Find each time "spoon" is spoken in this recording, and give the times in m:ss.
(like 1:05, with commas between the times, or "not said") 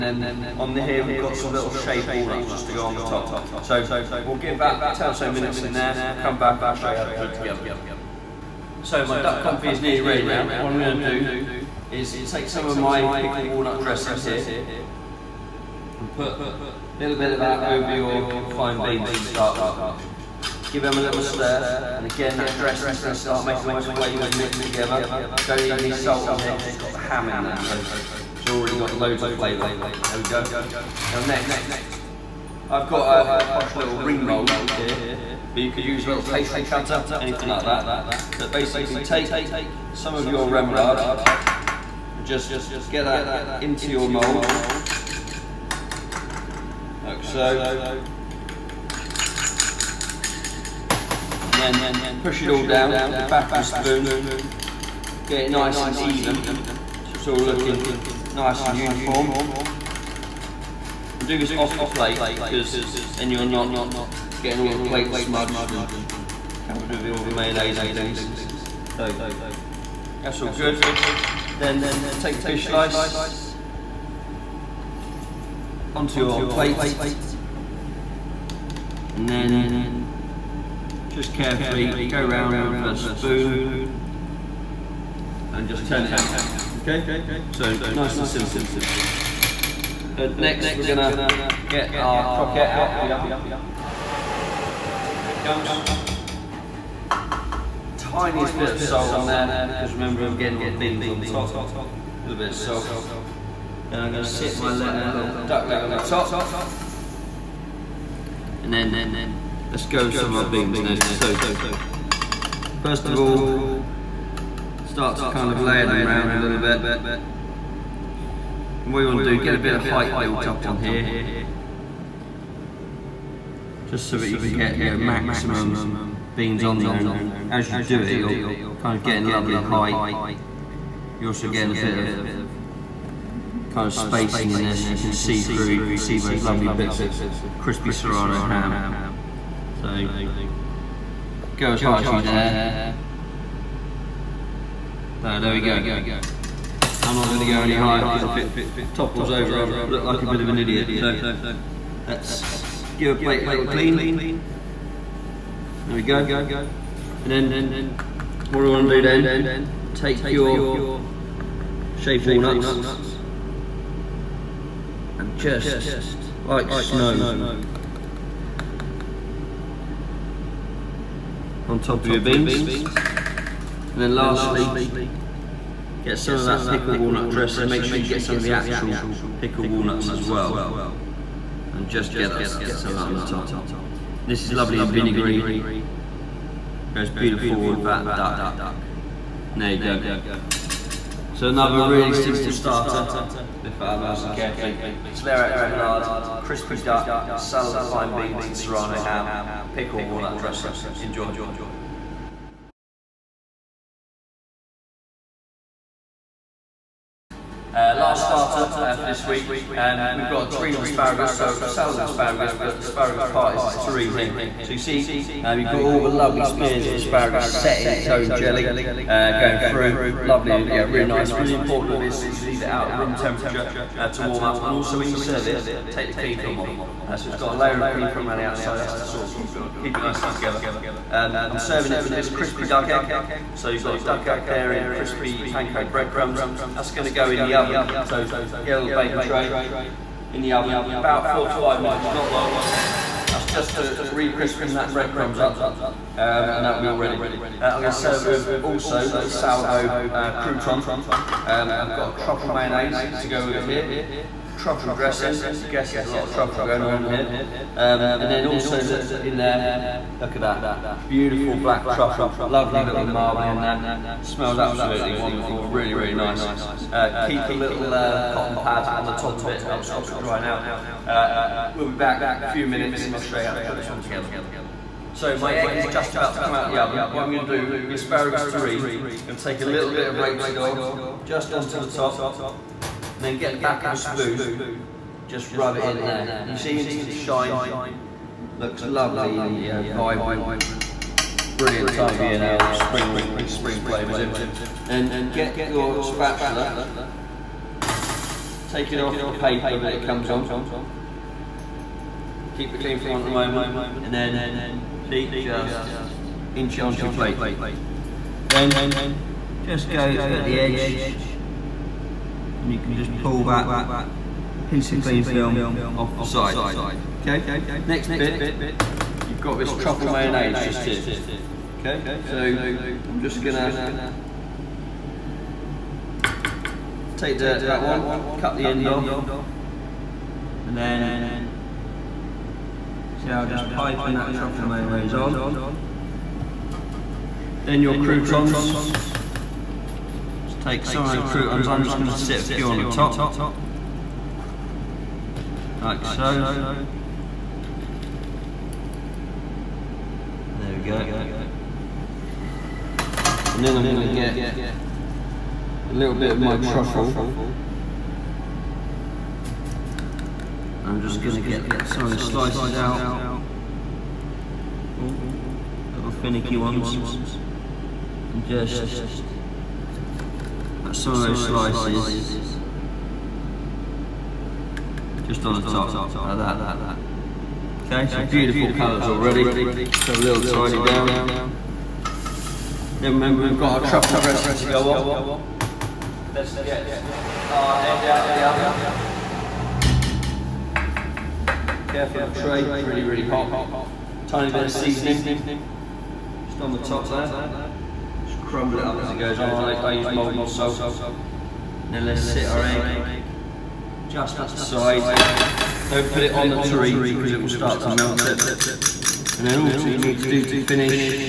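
0:53, 1:22, 4:43.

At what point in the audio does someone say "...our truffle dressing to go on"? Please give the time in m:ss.
6:23.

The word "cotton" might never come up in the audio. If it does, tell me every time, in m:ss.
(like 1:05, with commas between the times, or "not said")
4:28.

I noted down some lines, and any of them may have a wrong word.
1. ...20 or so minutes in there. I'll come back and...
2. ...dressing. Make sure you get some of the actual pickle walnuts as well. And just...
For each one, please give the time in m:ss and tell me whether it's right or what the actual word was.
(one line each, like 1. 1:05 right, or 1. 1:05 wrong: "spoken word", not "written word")
1. 0:04 wrong: "10", not "20"
2. 2:57 right.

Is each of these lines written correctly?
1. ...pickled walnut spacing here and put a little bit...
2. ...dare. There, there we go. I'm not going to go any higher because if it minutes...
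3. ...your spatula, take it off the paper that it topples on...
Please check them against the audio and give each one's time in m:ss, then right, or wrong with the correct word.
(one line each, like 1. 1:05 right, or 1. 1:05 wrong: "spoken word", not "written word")
1. 0:13 wrong: "dressing", not "spacing"
2. 2:22 wrong: "topples", not "minutes"
3. 4:55 wrong: "comes", not "topples".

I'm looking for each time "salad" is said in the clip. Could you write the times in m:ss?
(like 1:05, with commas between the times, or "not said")
3:17, 3:31.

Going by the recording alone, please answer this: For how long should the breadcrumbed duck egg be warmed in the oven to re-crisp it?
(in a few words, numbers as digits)
4 to 5 minutes.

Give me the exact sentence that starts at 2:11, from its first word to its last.
You're also getting a bit of kind of spacing in this.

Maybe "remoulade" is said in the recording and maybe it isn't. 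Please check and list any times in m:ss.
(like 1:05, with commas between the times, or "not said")
0:40, 3:15.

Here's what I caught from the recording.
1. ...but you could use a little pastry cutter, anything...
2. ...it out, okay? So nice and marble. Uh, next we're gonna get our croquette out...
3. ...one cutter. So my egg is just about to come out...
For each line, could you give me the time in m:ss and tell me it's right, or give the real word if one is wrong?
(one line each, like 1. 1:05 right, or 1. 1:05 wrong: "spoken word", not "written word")
1. 0:35 right
2. 1:26 wrong: "simple", not "marble"
3. 4:33 wrong: "together", not "cutter".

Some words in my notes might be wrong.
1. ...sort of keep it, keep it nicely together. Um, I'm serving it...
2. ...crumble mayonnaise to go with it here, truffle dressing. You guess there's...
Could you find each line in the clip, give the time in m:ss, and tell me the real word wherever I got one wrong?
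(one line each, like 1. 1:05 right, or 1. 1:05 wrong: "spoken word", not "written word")
1. 3:49 right
2. 4:12 wrong: "truffle", not "crumble".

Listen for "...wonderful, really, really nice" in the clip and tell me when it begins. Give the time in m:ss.
4:25.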